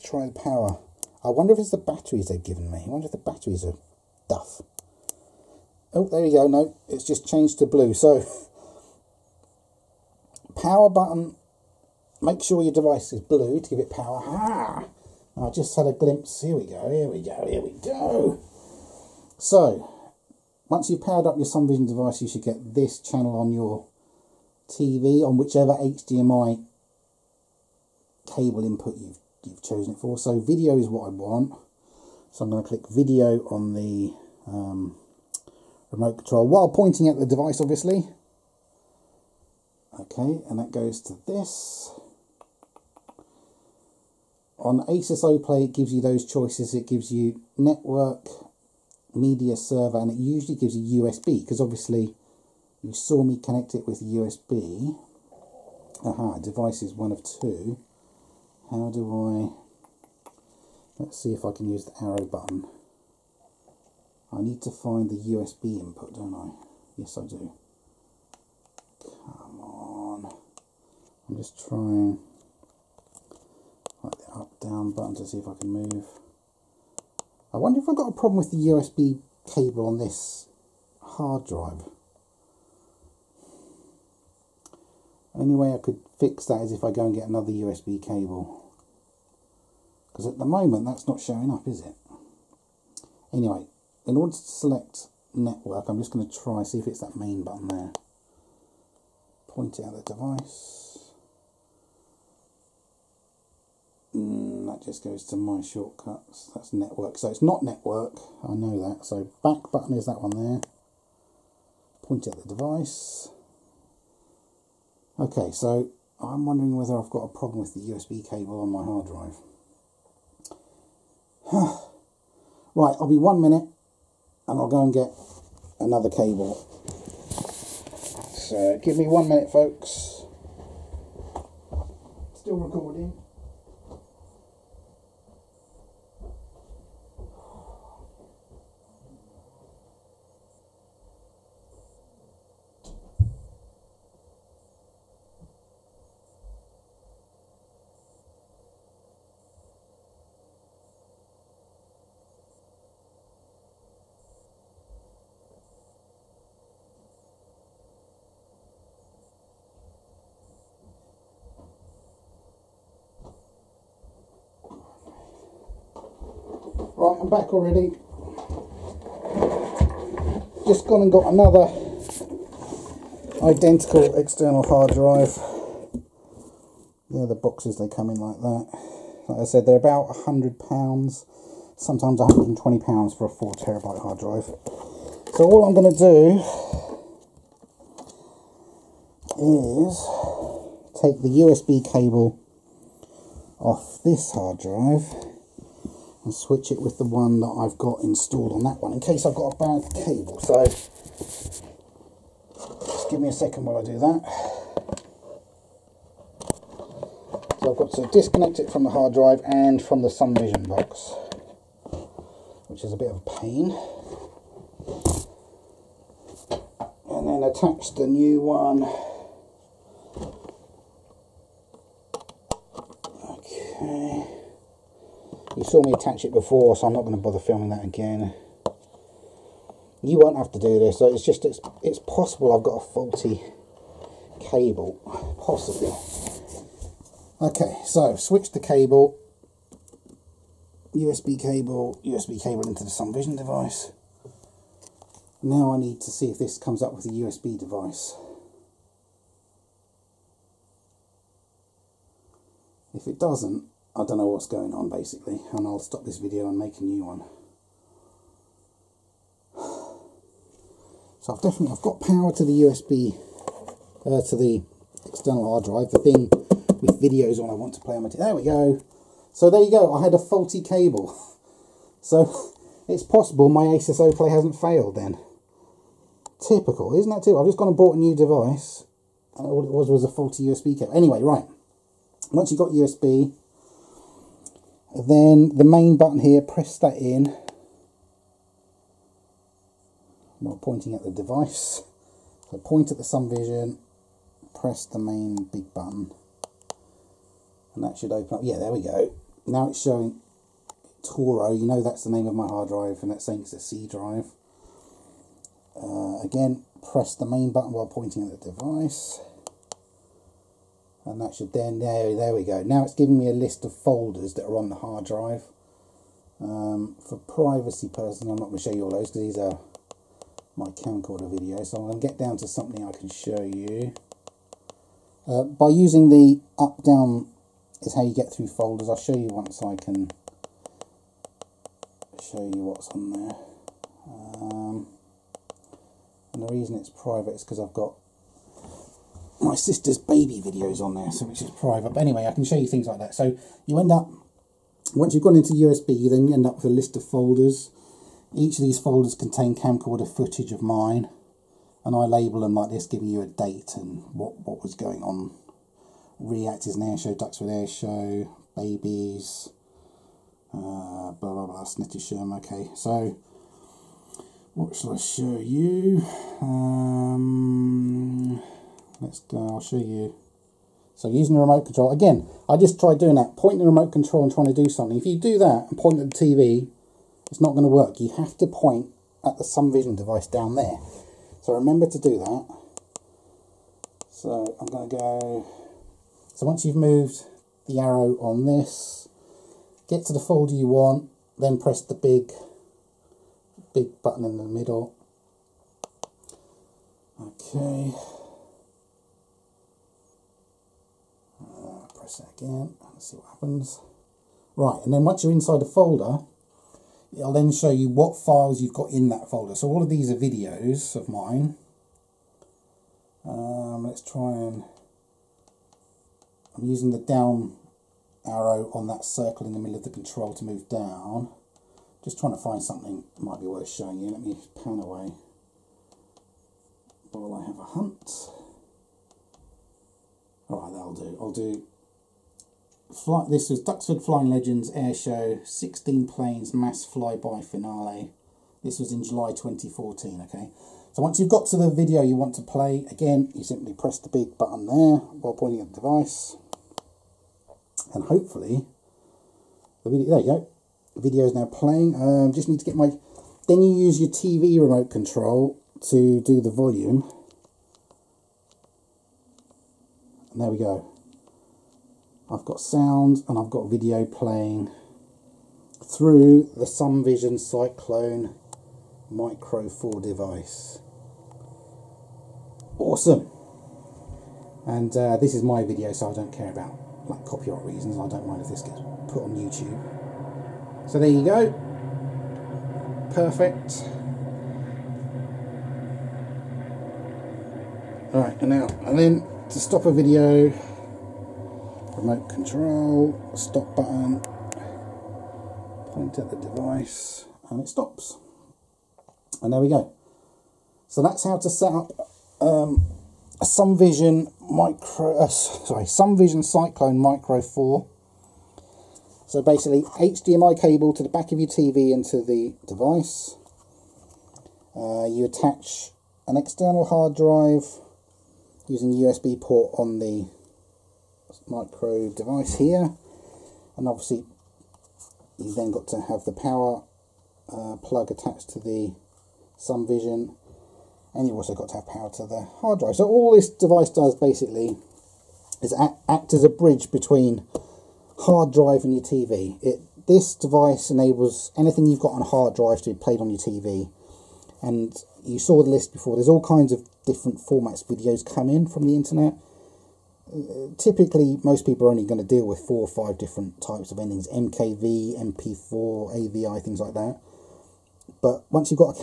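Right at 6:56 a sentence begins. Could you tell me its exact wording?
I'm using the down arrow on that circle in the middle of the control to move down.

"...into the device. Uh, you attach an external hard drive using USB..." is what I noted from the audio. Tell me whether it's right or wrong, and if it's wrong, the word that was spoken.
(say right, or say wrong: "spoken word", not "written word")
right.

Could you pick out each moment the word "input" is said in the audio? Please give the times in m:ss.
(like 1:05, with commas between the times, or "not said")
0:28, 1:05.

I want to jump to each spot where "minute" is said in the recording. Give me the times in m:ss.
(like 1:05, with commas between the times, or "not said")
2:03, 2:09.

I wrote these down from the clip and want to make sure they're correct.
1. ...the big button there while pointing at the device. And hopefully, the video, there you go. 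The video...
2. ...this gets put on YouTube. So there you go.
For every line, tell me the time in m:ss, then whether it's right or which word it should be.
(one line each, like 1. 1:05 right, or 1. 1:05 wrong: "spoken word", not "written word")
1. 7:23 right
2. 7:58 right.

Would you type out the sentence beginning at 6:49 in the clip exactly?
So all of these are videos of mine.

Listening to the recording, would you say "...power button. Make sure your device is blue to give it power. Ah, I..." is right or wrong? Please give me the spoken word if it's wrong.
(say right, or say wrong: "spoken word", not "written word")
right.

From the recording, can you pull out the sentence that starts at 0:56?
Aha, device is one of two how do I, let's see if I can use the arrow button.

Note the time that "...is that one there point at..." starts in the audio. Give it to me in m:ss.
1:49.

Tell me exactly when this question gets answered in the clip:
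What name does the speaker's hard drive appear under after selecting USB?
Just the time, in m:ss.
5:01.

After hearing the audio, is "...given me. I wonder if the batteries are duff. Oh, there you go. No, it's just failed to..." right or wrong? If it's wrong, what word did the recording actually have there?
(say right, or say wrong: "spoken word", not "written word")
wrong: "changed", not "failed".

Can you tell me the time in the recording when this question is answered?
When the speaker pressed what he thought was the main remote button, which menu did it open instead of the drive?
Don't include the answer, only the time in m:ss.
1:45.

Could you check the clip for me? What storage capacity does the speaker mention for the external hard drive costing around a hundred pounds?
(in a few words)
4 terabytes.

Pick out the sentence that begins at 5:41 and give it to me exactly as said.
But anyway, I can show you things like that.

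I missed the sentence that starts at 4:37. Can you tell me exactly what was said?
I've just gone and bought a new device and all it was was a faulty USB cable.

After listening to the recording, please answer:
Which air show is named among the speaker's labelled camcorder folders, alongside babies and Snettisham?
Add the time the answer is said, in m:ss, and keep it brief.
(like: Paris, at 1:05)
Duxford air show, at 5:57.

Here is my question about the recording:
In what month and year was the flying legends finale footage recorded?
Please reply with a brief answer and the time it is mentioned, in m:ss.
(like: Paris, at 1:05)
July 2014, at 7:19.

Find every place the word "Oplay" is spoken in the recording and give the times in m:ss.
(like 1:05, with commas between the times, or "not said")
0:45, 4:34.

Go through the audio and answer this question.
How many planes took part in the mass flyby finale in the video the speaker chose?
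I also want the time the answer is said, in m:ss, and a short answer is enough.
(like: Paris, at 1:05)
16, at 7:15.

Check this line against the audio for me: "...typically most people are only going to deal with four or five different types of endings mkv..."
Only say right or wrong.
right.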